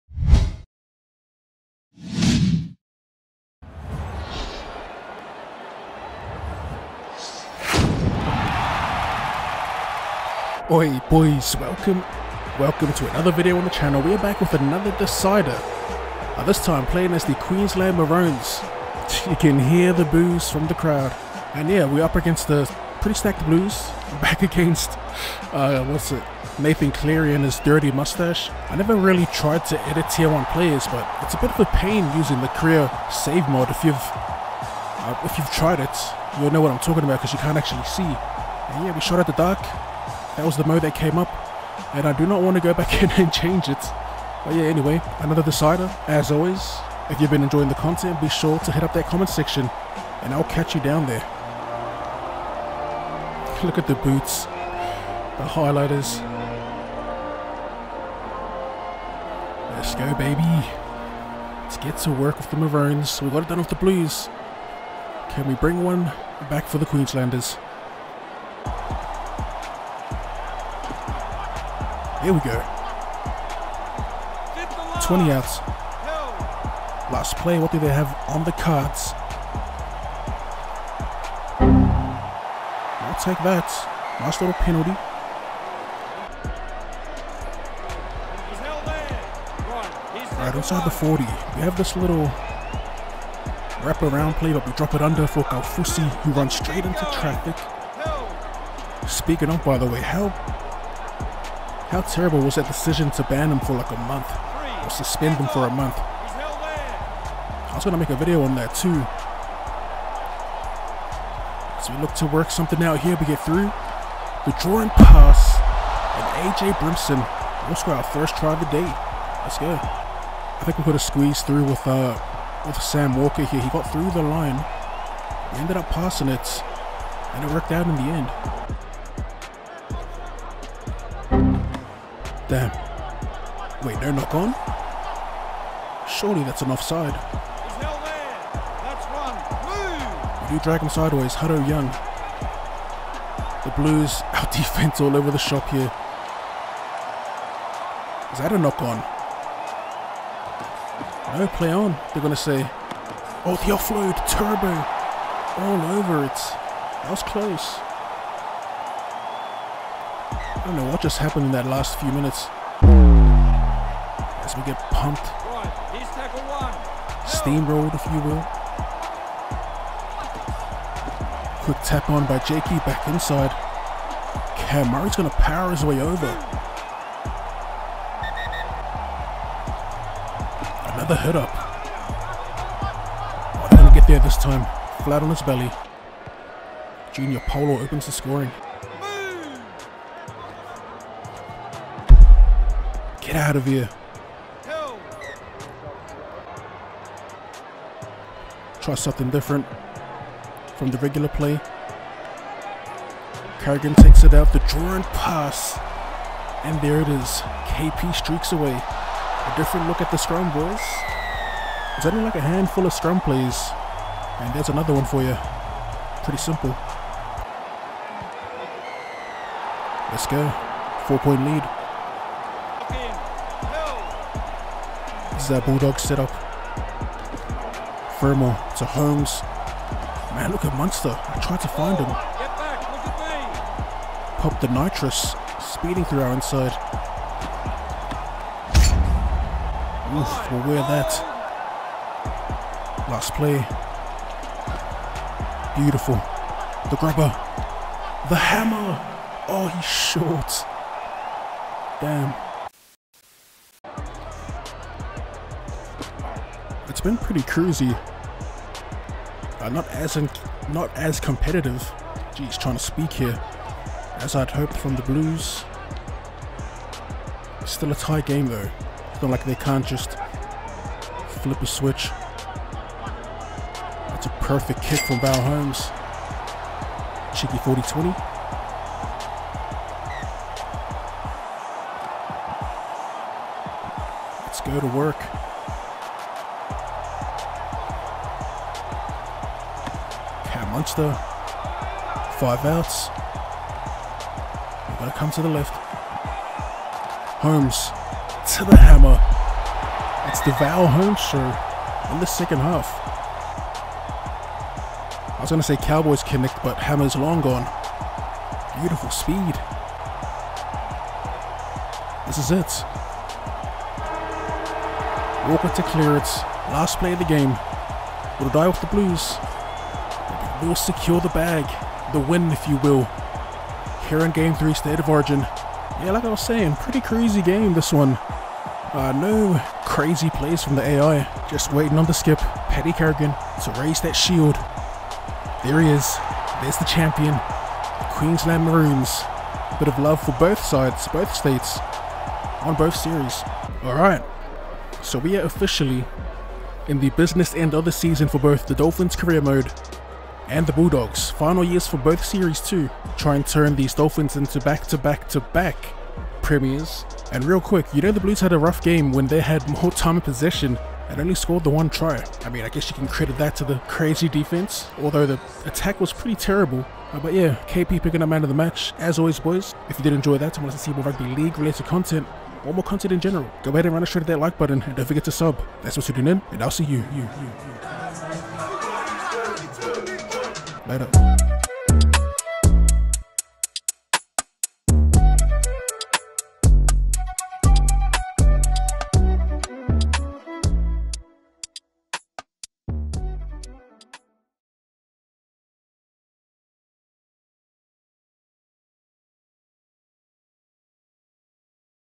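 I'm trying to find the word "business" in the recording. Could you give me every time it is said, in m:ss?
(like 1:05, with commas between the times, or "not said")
5:47.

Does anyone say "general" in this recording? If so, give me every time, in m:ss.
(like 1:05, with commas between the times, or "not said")
6:13.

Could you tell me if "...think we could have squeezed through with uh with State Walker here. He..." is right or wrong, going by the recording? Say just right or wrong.
wrong.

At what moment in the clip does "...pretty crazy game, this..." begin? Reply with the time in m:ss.
5:26.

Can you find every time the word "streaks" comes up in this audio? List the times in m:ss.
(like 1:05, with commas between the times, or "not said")
3:28.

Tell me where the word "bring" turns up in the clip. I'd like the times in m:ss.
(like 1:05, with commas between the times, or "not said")
1:05.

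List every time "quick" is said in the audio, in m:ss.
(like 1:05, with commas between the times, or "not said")
2:51, 5:57.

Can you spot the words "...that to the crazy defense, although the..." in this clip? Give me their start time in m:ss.
6:03.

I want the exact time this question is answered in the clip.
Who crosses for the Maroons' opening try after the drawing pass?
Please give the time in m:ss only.
1:56.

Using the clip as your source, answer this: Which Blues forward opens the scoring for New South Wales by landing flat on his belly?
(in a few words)
Junior Paulo.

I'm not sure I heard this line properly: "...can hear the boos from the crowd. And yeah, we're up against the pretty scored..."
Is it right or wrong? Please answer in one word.
wrong.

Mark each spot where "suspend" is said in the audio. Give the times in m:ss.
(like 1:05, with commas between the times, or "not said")
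1:44.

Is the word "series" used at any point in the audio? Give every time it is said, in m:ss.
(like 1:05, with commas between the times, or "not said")
5:42, 5:52.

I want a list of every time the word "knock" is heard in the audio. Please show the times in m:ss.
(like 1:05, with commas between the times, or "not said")
2:14, 2:28.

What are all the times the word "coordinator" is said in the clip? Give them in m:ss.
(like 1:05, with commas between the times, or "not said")
not said.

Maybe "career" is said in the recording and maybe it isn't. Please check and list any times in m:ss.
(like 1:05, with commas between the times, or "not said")
0:32, 5:49.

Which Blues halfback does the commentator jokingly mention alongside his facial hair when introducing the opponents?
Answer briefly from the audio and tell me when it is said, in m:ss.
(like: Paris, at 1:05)
Nathan Cleary, at 0:26.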